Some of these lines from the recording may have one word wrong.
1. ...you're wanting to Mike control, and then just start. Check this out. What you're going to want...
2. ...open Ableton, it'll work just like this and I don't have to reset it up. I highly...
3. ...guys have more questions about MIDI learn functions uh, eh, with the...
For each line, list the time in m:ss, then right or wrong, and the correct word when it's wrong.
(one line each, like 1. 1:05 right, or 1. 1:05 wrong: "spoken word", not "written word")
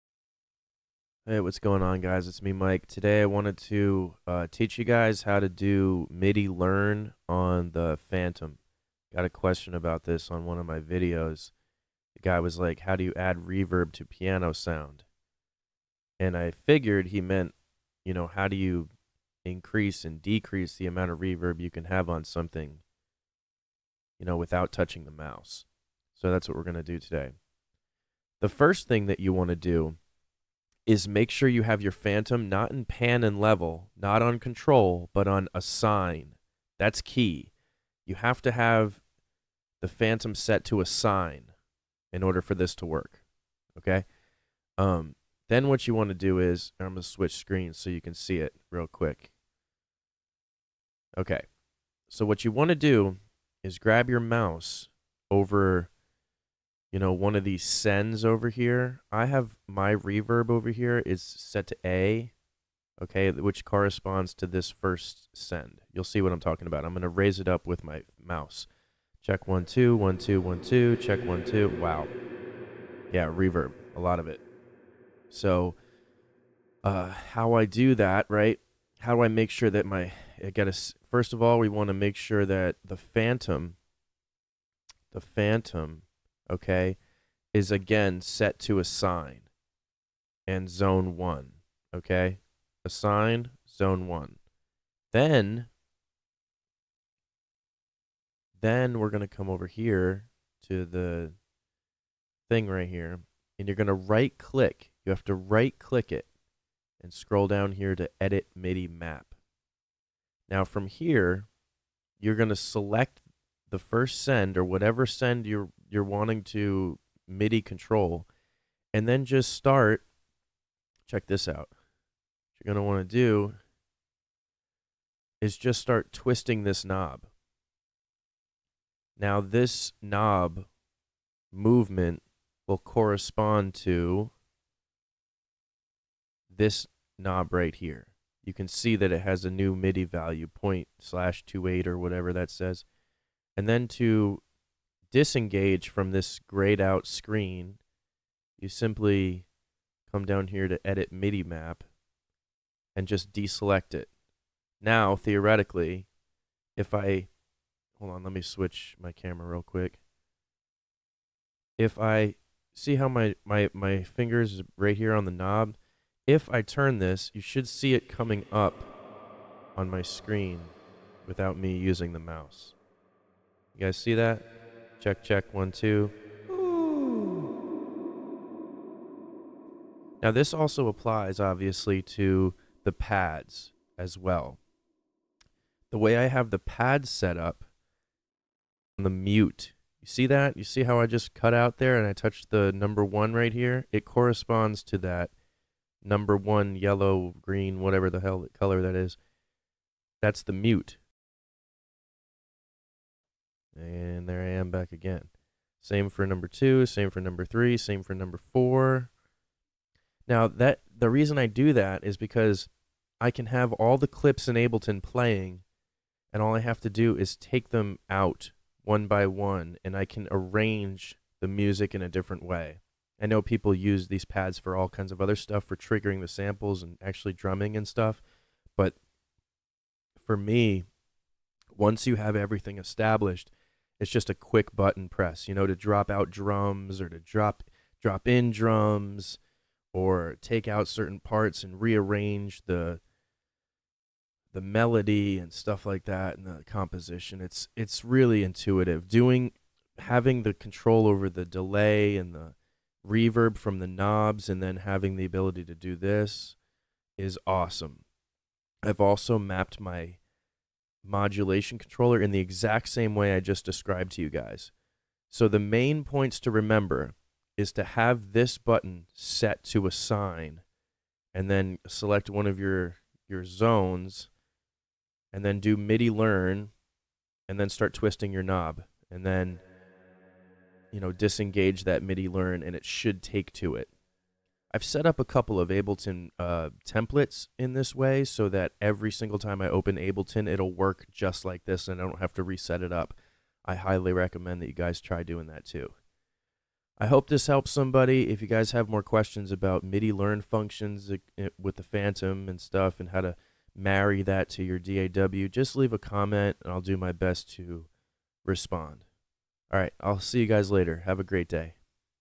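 1. 1:55 wrong: "MIDI", not "Mike"
2. 4:49 right
3. 4:58 right.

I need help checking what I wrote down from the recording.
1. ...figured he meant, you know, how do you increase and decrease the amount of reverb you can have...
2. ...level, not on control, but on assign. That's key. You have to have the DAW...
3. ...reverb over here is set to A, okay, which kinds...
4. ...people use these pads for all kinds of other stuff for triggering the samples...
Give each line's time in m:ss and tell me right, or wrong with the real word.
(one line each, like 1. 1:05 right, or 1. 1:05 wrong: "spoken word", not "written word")
1. 0:16 right
2. 0:33 wrong: "Fantom", not "DAW"
3. 0:59 wrong: "corresponds", not "kinds"
4. 3:43 right.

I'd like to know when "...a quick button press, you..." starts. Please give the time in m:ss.
3:54.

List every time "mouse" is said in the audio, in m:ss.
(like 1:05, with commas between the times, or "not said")
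0:25, 0:54, 1:08, 2:52.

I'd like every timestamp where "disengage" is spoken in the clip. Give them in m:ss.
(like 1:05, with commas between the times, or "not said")
2:25, 4:41.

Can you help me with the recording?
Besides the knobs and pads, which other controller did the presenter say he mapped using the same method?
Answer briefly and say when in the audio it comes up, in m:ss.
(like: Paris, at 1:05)
modulation controller, at 4:21.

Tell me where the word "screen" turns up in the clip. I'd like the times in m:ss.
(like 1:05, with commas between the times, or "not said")
0:47, 2:27, 2:50.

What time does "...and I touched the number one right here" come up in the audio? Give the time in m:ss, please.
3:11.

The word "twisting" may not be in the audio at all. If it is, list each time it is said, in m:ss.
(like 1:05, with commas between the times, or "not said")
2:06, 4:37.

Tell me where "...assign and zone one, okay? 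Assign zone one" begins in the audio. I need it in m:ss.
1:28.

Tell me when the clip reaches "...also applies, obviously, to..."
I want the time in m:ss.
3:00.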